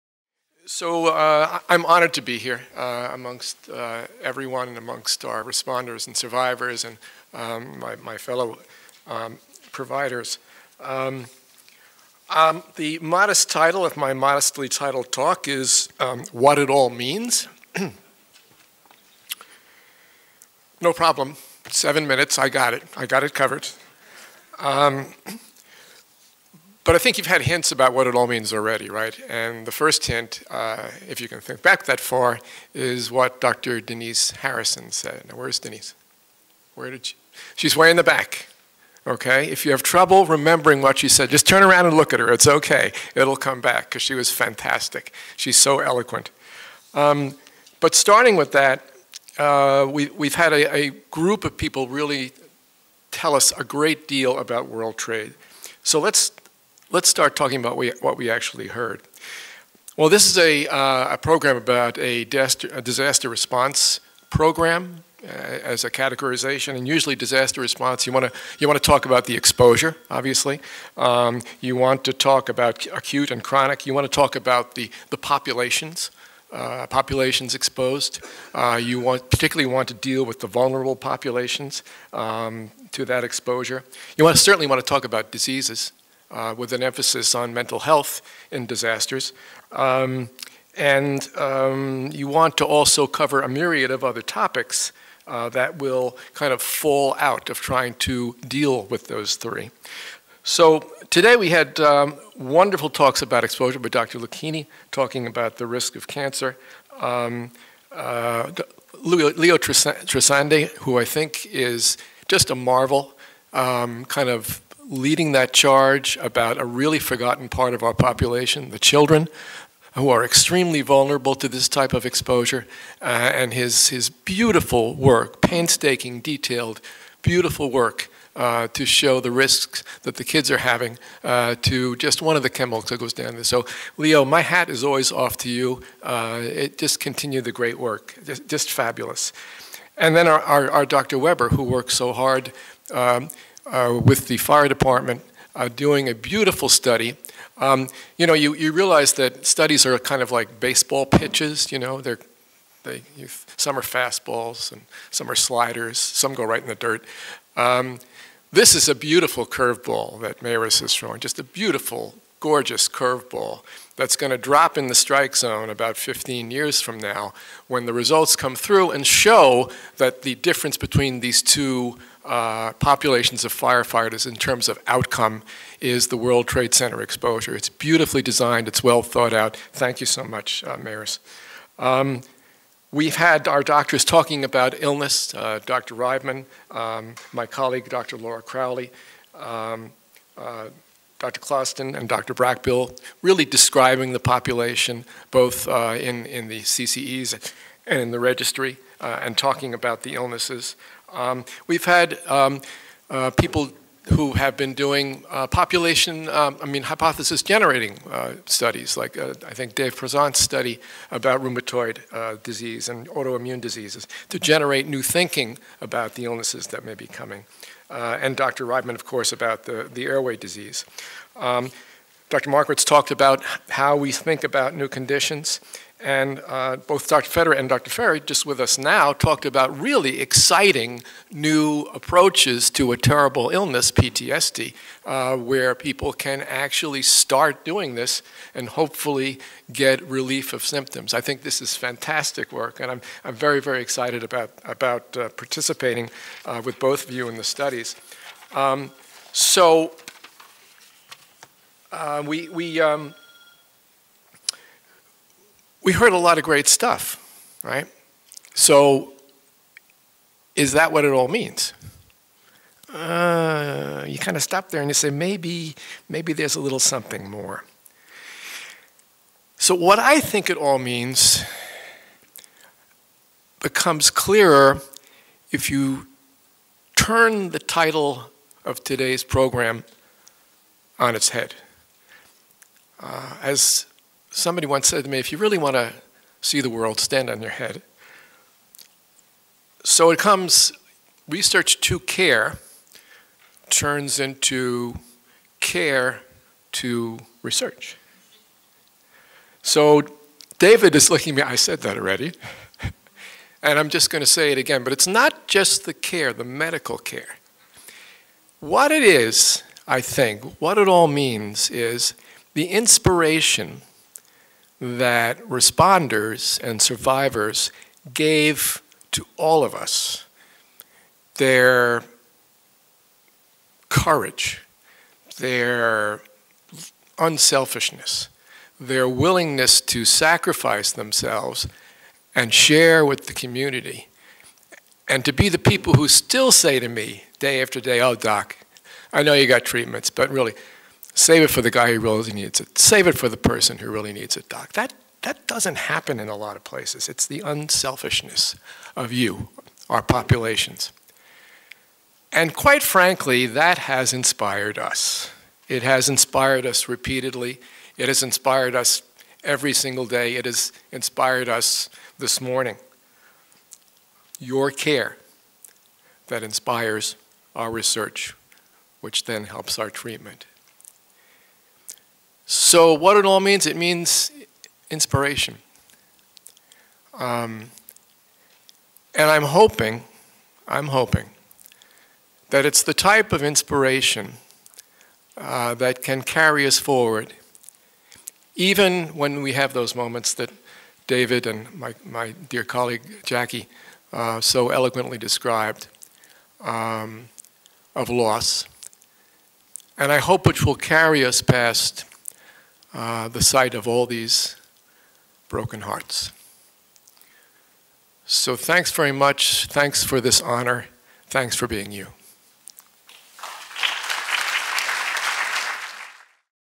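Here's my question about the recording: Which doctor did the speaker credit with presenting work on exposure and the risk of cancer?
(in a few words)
Dr. Lucchini.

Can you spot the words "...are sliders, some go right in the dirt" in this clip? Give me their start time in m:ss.
2:35.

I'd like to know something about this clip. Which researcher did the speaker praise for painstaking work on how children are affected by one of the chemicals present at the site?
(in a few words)
Leo Trasande.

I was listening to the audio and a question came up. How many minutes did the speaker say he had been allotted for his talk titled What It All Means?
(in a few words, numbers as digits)
7.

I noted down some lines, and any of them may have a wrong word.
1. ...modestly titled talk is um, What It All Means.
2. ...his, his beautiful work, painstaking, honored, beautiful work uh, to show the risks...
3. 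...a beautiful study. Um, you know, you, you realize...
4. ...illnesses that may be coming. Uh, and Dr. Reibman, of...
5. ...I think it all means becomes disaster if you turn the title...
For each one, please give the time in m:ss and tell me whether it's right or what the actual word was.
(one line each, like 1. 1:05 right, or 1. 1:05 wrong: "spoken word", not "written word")
1. 0:14 right
2. 2:03 wrong: "detailed", not "honored"
3. 2:26 right
4. 3:36 right
5. 4:29 wrong: "clearer", not "disaster".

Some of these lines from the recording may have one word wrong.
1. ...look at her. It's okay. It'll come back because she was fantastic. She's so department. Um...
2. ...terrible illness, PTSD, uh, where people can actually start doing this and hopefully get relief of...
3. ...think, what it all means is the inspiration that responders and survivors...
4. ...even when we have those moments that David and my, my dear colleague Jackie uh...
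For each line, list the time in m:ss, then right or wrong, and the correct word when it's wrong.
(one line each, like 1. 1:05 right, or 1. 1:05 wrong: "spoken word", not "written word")
1. 0:41 wrong: "eloquent", not "department"
2. 3:52 right
3. 5:10 right
4. 6:28 right.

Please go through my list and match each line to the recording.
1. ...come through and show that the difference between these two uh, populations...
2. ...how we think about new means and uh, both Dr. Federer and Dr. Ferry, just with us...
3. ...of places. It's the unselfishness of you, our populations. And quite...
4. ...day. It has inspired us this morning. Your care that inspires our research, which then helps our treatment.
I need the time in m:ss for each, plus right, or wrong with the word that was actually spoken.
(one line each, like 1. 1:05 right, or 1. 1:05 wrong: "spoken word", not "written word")
1. 2:48 right
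2. 3:43 wrong: "conditions", not "means"
3. 5:46 right
4. 6:00 right.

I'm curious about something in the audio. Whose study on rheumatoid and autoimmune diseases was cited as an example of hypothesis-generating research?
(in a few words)
Dave Prezant.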